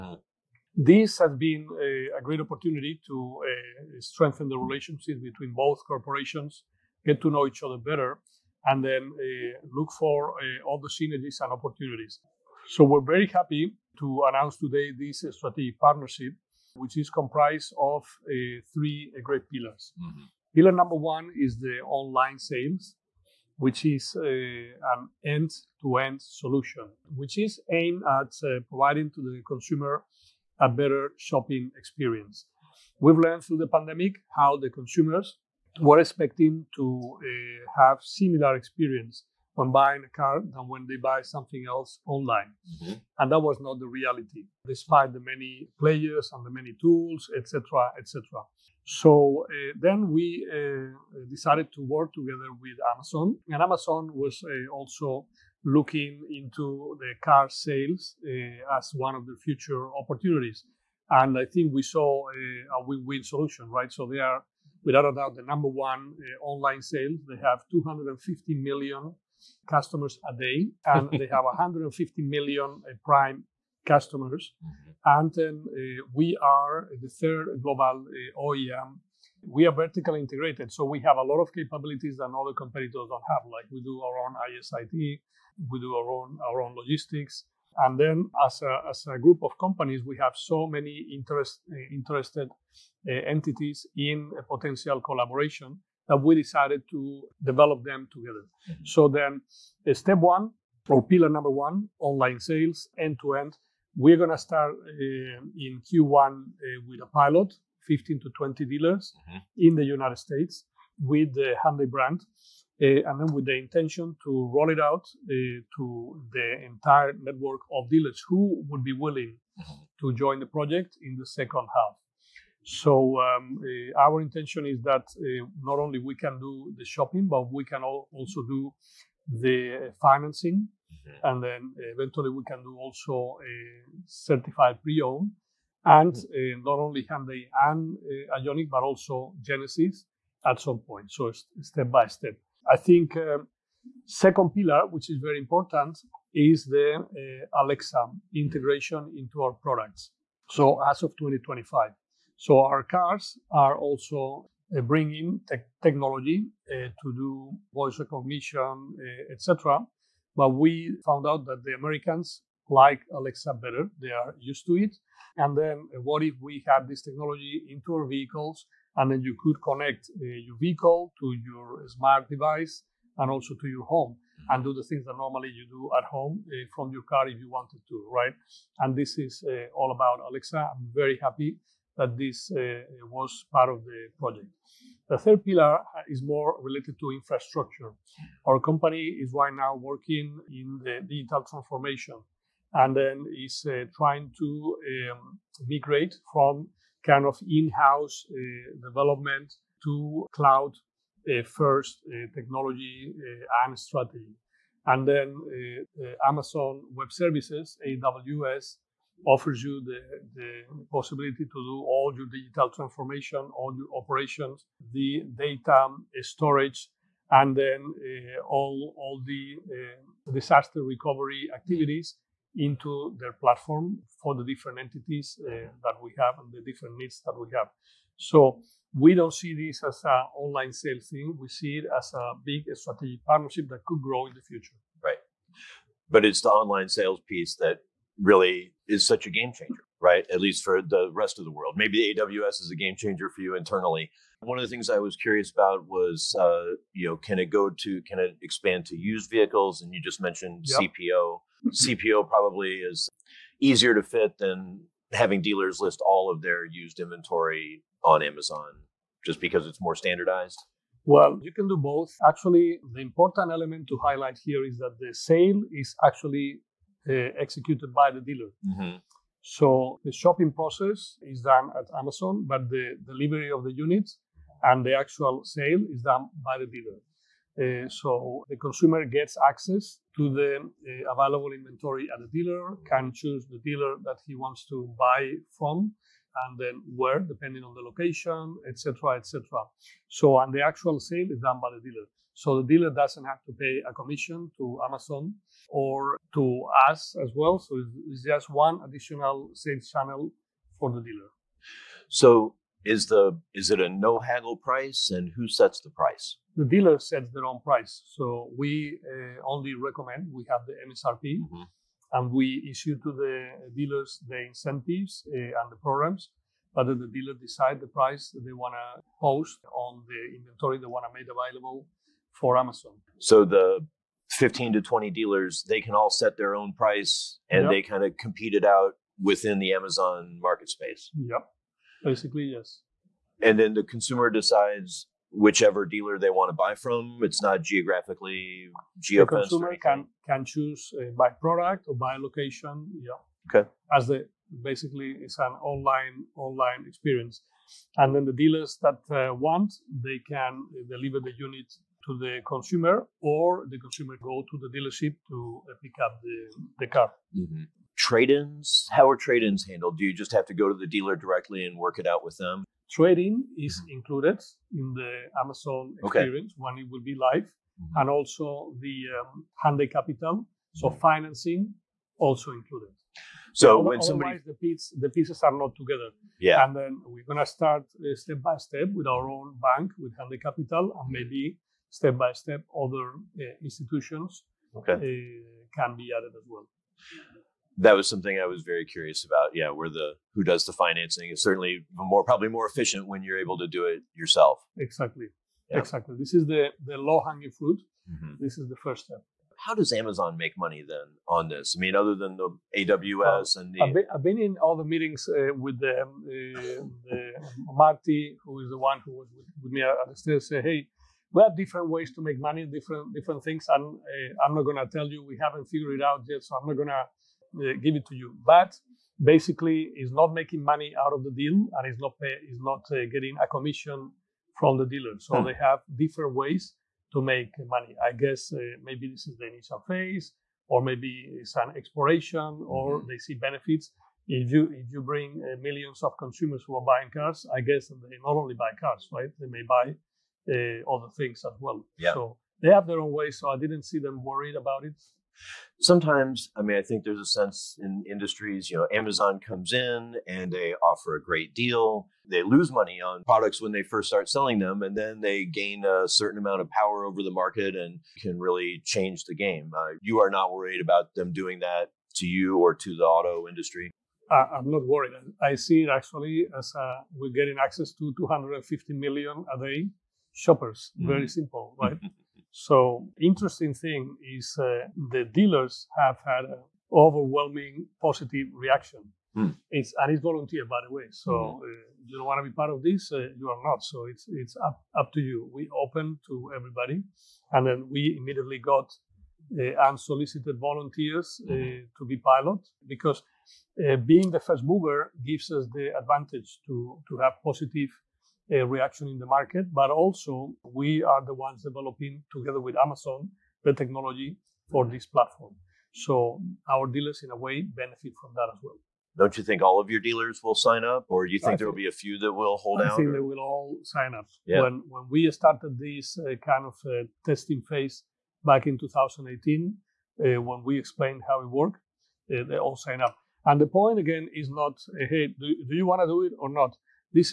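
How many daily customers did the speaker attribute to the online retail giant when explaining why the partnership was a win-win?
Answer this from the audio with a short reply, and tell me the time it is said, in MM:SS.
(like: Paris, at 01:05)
250 million, at 01:07.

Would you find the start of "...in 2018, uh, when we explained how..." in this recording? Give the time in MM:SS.
08:38.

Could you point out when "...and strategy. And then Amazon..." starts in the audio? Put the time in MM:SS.
03:23.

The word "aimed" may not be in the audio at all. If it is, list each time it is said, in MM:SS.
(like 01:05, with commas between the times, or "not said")
00:27.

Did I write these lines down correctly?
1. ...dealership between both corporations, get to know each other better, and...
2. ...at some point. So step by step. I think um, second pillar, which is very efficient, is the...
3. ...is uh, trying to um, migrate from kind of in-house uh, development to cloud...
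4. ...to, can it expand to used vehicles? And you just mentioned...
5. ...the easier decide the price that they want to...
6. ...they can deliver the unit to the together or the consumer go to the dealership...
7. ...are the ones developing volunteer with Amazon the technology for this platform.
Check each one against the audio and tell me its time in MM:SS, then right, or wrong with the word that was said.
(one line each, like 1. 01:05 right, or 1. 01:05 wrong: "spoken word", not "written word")
1. 00:04 wrong: "relationship", not "dealership"
2. 02:20 wrong: "important", not "efficient"
3. 03:13 right
4. 04:07 right
5. 05:16 wrong: "dealer", not "easier"
6. 05:50 wrong: "consumer", not "together"
7. 08:21 wrong: "together", not "volunteer".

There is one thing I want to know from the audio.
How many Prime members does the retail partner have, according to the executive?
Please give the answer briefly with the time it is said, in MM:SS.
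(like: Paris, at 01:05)
150 million, at 01:11.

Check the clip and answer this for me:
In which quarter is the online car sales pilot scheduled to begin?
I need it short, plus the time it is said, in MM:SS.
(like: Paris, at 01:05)
Q1, at 01:45.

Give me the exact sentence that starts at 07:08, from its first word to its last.
I guess maybe this is the initial phase, or maybe it's an exploration, or mm-hmm.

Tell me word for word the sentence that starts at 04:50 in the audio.
So, and the actual sale is done by the dealer.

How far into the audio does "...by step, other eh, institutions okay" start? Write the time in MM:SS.
06:22.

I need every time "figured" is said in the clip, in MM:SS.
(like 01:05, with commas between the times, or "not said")
06:55.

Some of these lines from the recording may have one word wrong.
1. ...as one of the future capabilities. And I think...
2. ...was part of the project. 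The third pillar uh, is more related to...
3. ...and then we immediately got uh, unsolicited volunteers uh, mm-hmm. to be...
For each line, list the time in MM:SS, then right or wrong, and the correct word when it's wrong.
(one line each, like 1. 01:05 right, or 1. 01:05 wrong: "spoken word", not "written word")
1. 00:58 wrong: "opportunities", not "capabilities"
2. 03:03 right
3. 08:07 right.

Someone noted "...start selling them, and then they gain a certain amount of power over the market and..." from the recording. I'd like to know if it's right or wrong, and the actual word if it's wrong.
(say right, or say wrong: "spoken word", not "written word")
right.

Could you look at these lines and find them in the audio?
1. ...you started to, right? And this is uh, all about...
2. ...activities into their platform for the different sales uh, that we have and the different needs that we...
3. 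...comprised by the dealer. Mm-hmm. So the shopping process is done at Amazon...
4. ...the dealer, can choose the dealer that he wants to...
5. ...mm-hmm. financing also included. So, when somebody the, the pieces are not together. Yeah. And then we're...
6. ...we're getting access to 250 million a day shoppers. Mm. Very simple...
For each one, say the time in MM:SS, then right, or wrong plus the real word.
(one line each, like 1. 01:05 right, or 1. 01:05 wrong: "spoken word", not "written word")
1. 02:57 wrong: "wanted", not "started"
2. 03:41 wrong: "entities", not "sales"
3. 04:27 wrong: "executed", not "comprised"
4. 04:42 right
5. 06:10 right
6. 07:47 right.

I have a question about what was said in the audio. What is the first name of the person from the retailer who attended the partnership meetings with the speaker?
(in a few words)
Marty.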